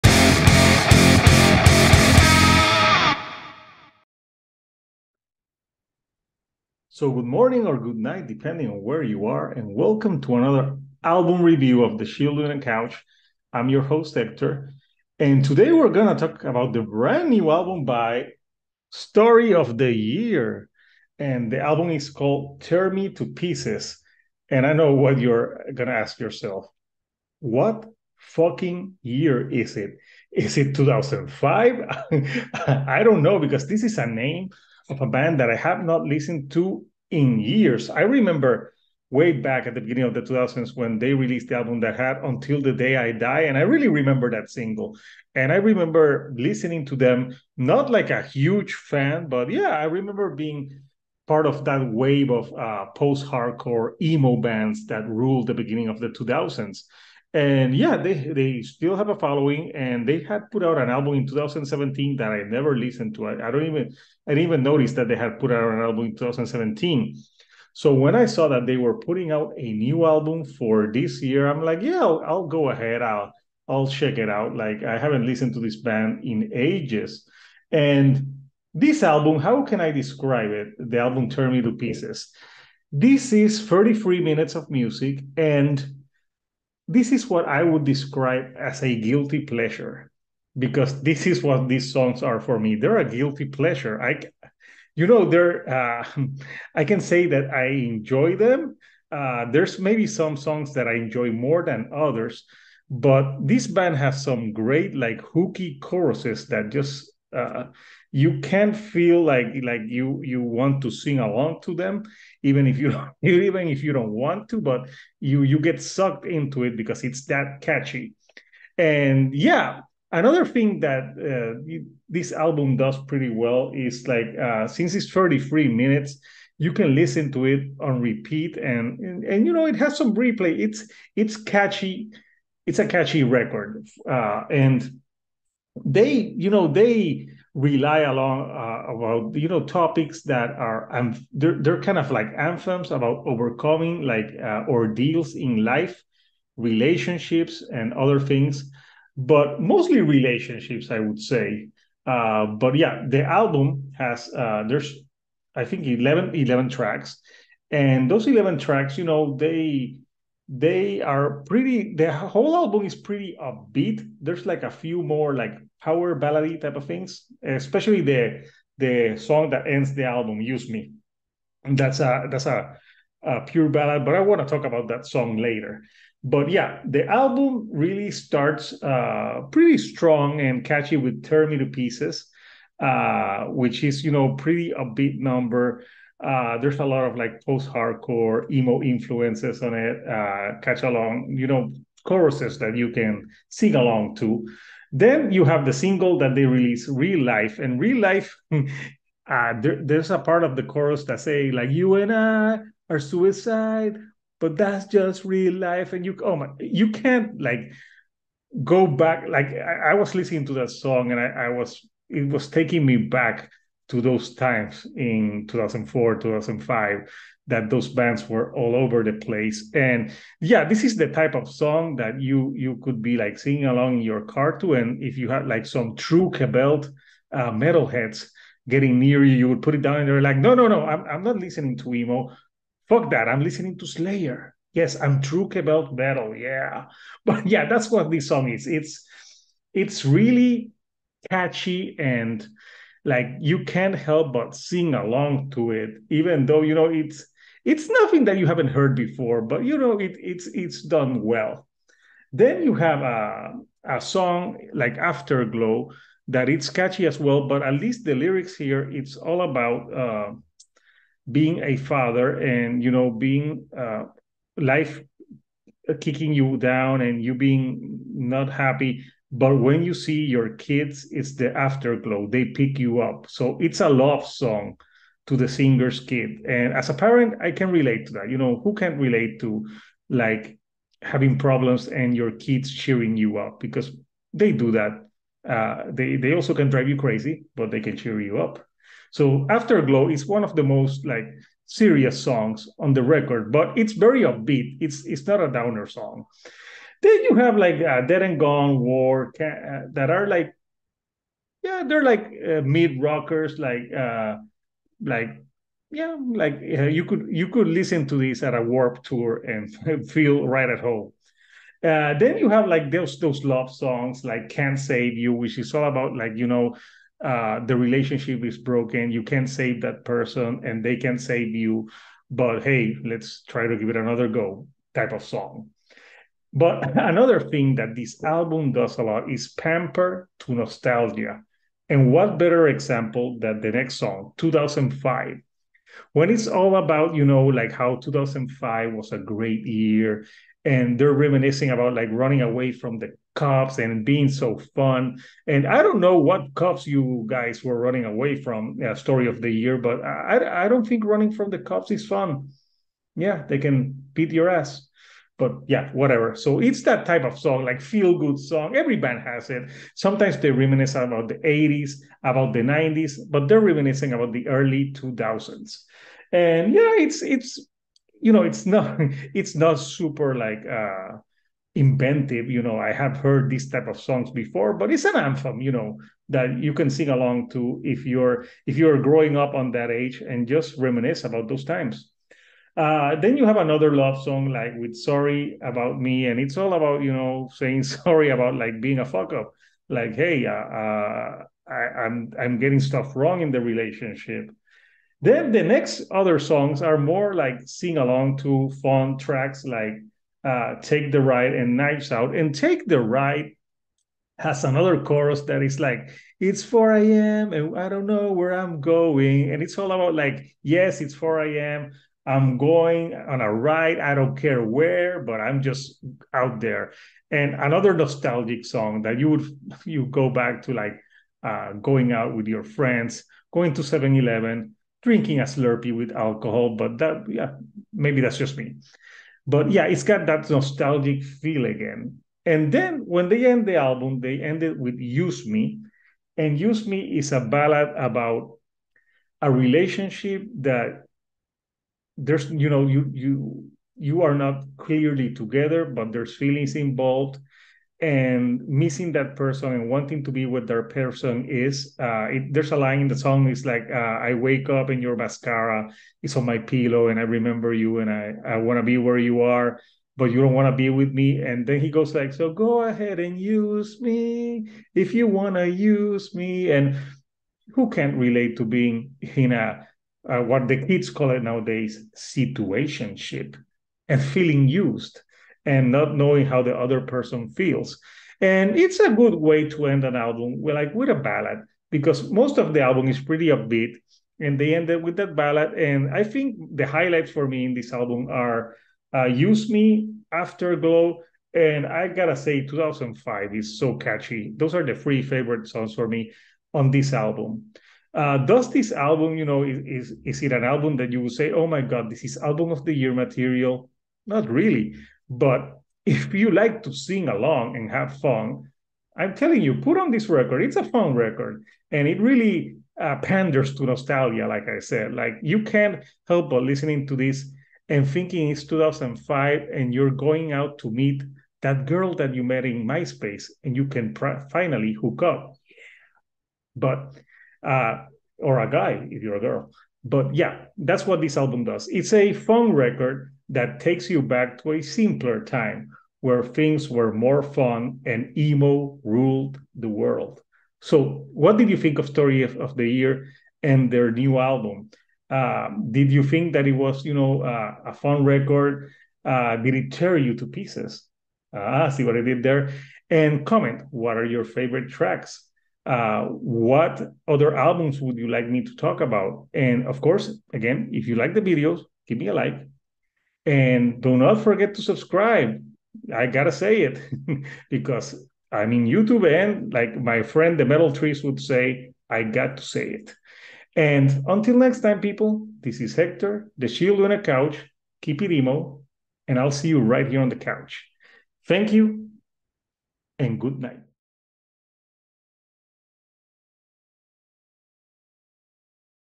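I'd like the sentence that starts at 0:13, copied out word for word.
I'm your host, Hector, and today we're going to talk about the brand new album by Story of the Year.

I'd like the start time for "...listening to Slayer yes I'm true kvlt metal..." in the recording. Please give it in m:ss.
3:53.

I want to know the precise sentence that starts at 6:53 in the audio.
I don't care where, but I'm just out there.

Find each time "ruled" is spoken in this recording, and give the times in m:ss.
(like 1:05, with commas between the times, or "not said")
0:55, 8:59.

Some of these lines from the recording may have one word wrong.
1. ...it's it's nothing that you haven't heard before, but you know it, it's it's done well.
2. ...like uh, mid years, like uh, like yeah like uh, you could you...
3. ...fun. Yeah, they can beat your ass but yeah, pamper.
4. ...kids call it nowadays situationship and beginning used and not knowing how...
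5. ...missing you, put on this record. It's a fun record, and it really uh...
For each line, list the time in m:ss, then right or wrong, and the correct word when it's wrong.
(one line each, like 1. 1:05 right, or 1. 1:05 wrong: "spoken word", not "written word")
1. 4:06 right
2. 5:02 wrong: "rockers", not "years"
3. 5:52 wrong: "whatever", not "pamper"
4. 7:50 wrong: "feeling", not "beginning"
5. 8:29 wrong: "telling", not "missing".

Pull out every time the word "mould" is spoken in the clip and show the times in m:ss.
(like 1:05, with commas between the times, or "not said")
not said.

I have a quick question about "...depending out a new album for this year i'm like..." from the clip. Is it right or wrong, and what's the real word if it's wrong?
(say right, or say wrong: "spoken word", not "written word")
wrong: "putting", not "depending".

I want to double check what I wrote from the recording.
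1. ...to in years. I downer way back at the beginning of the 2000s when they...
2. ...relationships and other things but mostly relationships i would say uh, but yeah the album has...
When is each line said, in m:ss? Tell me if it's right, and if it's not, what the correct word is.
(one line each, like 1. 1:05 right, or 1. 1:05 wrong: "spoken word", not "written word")
1. 0:36 wrong: "remember", not "downer"
2. 2:26 right.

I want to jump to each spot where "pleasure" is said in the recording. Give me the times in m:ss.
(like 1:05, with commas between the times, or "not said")
1:29, 1:33.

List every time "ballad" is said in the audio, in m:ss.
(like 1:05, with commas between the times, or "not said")
2:46, 2:53, 7:17, 8:01, 8:05.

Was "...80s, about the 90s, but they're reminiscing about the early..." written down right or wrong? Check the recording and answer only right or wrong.
right.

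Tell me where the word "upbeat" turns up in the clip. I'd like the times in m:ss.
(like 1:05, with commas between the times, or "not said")
2:43, 3:04, 4:54, 8:03.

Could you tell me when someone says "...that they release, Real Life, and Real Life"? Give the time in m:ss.
3:16.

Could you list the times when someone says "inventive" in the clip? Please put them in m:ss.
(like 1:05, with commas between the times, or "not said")
6:11.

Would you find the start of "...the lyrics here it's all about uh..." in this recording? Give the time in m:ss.
4:18.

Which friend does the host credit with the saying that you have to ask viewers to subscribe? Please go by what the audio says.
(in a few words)
the Metal Trees.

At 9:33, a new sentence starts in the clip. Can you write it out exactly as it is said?
And until next time, people, this is Hector, the Chill Dude on a Couch.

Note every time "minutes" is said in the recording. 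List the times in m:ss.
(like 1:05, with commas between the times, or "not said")
1:24, 2:05.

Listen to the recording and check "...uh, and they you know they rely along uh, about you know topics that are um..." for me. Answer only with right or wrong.
right.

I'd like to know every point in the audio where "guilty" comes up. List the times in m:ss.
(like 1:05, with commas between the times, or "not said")
1:28, 1:33.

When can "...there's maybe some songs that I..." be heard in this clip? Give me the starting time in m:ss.
1:39.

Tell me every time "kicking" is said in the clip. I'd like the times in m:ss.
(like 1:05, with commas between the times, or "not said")
4:25.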